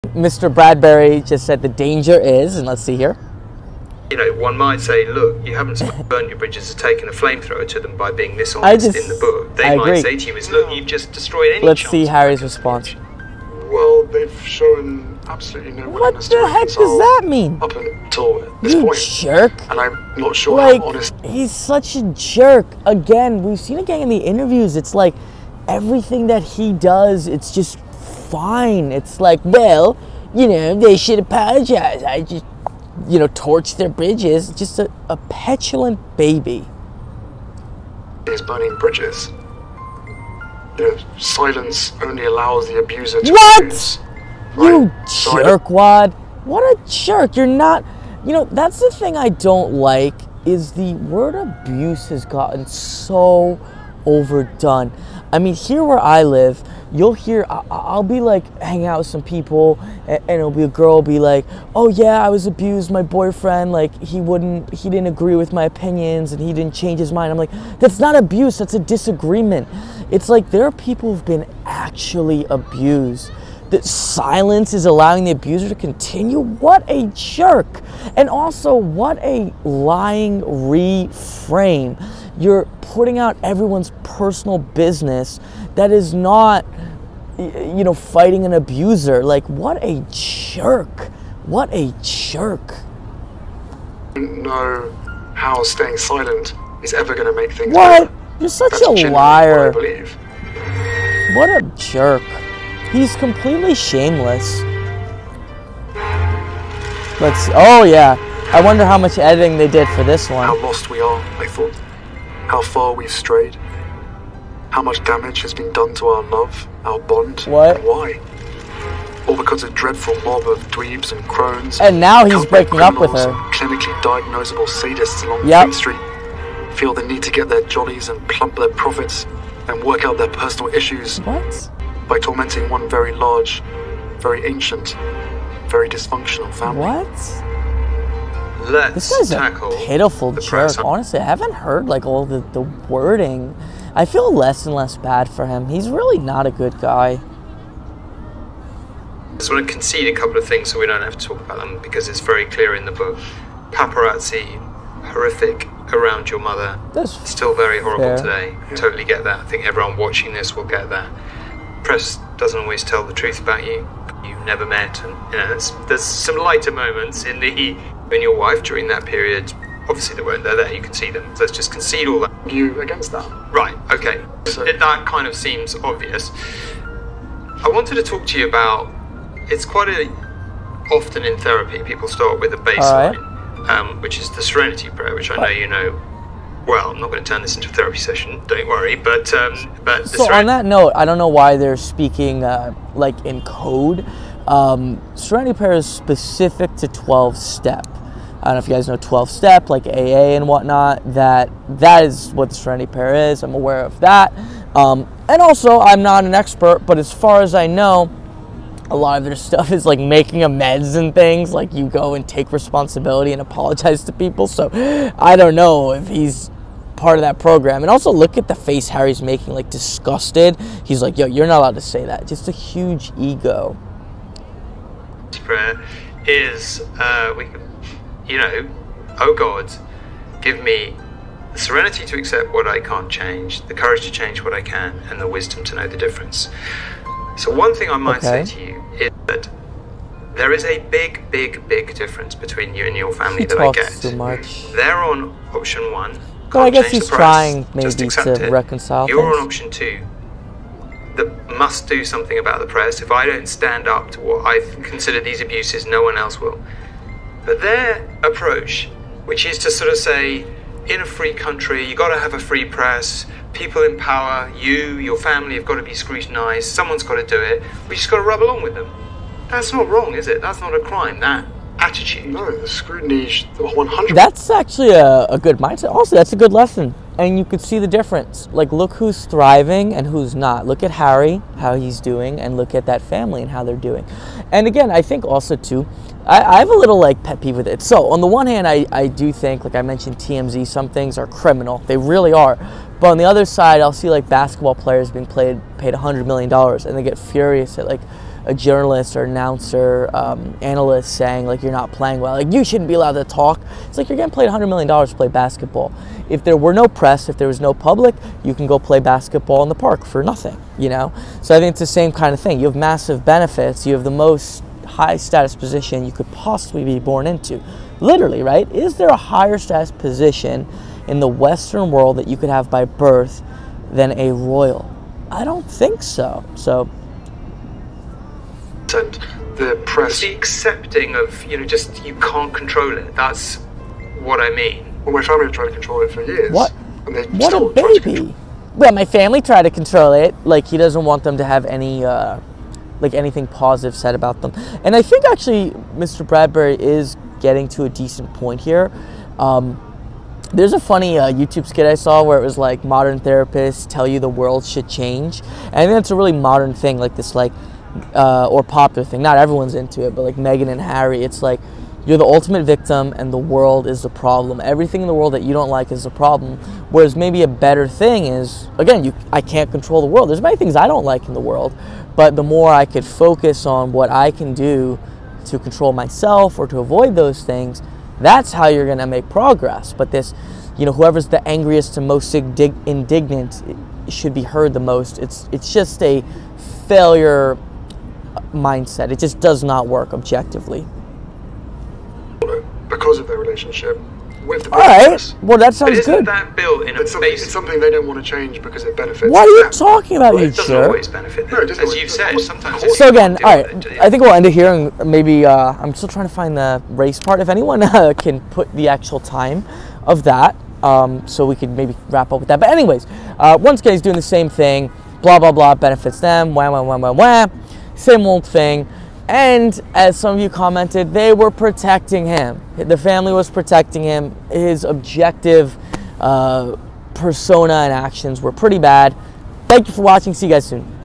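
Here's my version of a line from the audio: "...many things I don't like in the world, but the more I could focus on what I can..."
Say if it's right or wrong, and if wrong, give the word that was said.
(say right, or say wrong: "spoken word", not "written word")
right.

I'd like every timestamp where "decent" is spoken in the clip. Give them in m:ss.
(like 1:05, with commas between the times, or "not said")
5:47.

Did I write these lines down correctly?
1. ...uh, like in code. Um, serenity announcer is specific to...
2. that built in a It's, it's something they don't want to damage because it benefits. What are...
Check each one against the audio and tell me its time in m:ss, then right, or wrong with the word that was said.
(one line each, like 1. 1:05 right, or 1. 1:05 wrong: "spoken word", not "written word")
1. 3:12 wrong: "prayer", not "announcer"
2. 6:36 wrong: "change", not "damage".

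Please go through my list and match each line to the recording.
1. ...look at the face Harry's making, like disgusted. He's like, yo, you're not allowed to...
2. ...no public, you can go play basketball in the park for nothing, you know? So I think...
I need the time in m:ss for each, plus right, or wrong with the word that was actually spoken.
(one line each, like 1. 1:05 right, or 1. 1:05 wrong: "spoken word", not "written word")
1. 3:38 right
2. 5:07 right.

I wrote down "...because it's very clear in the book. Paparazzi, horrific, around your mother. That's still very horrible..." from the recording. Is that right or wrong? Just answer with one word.
right.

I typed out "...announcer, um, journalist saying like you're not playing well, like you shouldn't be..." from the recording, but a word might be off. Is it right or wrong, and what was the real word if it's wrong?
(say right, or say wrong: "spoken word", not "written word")
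wrong: "analyst", not "journalist".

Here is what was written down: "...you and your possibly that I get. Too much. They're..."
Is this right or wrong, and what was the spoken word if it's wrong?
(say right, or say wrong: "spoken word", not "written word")
wrong: "family", not "possibly".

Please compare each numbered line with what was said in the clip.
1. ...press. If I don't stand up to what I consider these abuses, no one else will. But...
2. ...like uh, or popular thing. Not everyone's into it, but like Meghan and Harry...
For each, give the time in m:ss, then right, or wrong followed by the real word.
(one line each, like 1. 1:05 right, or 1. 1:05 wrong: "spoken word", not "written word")
1. 4:12 right
2. 5:57 right.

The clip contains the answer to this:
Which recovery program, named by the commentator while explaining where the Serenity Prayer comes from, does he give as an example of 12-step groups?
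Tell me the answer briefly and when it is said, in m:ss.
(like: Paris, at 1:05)
AA, at 3:19.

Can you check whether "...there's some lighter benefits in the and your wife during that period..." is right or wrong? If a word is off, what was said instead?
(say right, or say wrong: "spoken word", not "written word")
wrong: "moments", not "benefits".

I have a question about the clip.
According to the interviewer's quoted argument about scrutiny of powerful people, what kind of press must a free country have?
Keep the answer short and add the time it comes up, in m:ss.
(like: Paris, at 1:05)
A free press, at 4:22.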